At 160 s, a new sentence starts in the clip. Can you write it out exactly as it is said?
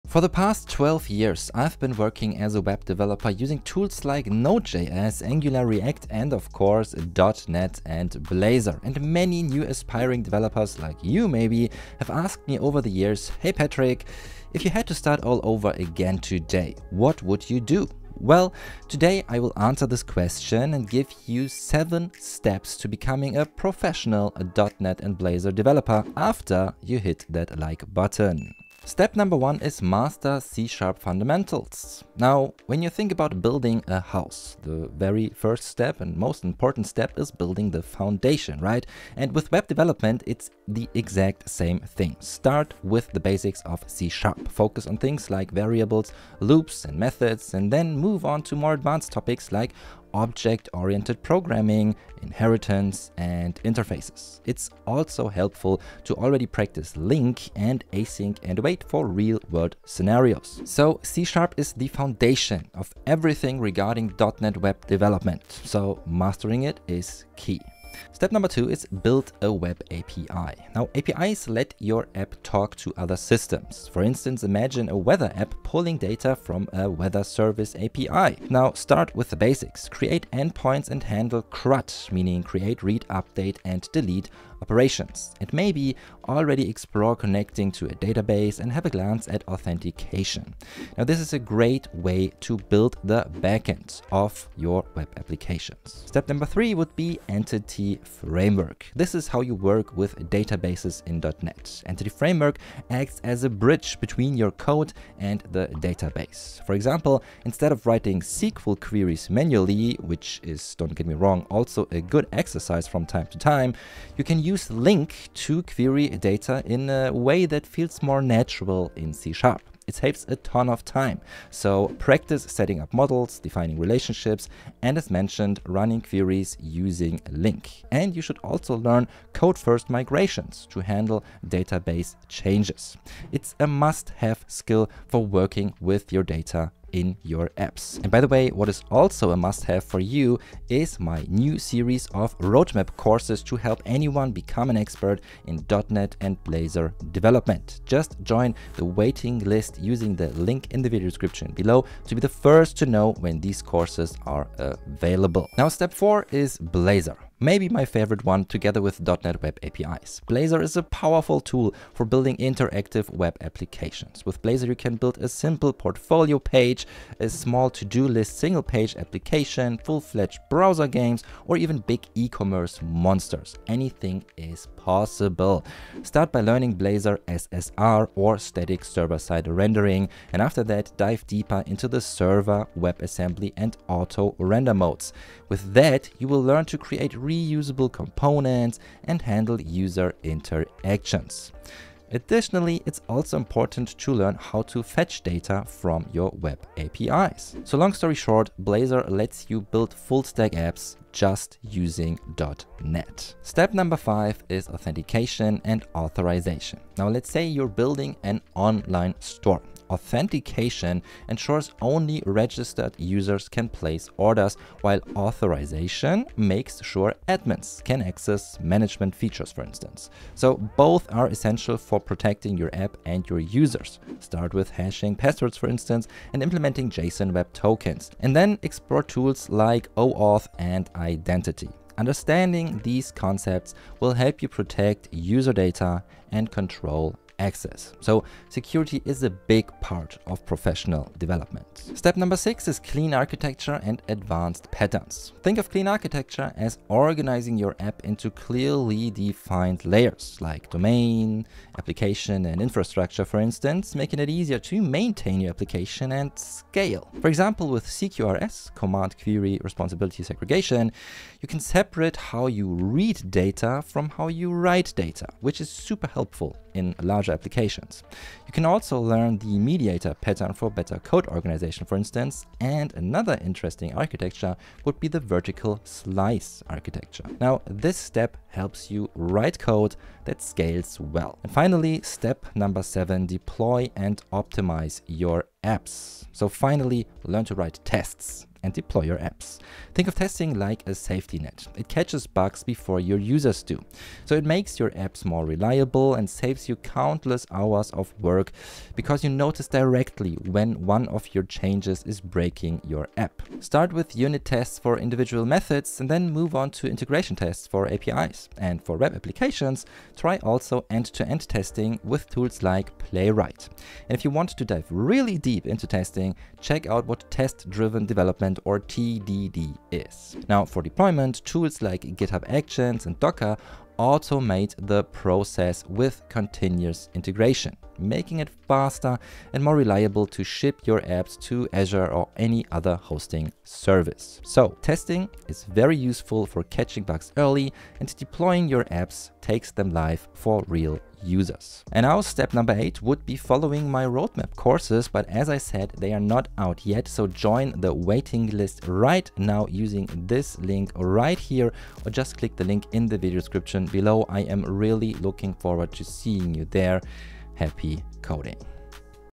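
Blazor is a powerful tool for building interactive web applications.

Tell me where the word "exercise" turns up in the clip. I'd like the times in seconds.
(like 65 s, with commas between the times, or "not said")
112 s.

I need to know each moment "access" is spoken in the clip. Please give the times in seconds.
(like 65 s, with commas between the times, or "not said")
218 s, 237 s.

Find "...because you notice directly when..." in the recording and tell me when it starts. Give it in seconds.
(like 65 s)
298 s.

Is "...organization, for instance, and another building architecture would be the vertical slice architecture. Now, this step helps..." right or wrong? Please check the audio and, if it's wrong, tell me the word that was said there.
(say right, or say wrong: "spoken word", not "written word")
wrong: "interesting", not "building".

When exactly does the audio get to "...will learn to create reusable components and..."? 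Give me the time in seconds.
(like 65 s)
186 s.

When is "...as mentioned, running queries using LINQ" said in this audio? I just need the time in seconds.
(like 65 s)
124 s.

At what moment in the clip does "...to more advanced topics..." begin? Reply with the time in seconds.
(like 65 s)
48 s.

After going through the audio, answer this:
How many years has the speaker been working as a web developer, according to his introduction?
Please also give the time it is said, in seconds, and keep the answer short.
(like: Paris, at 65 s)
12, at 0 s.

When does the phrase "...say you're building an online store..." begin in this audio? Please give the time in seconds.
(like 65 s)
207 s.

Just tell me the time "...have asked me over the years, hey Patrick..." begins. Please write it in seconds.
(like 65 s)
11 s.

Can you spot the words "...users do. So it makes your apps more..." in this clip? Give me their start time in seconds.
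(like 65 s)
293 s.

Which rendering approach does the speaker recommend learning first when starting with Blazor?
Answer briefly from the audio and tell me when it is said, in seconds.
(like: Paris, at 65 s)
static server-side rendering, at 178 s.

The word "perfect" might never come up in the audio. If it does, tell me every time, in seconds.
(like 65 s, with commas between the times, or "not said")
not said.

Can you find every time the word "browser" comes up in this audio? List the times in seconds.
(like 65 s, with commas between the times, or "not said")
170 s.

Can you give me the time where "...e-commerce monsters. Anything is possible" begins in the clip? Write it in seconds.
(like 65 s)
172 s.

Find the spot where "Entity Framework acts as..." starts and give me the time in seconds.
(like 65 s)
101 s.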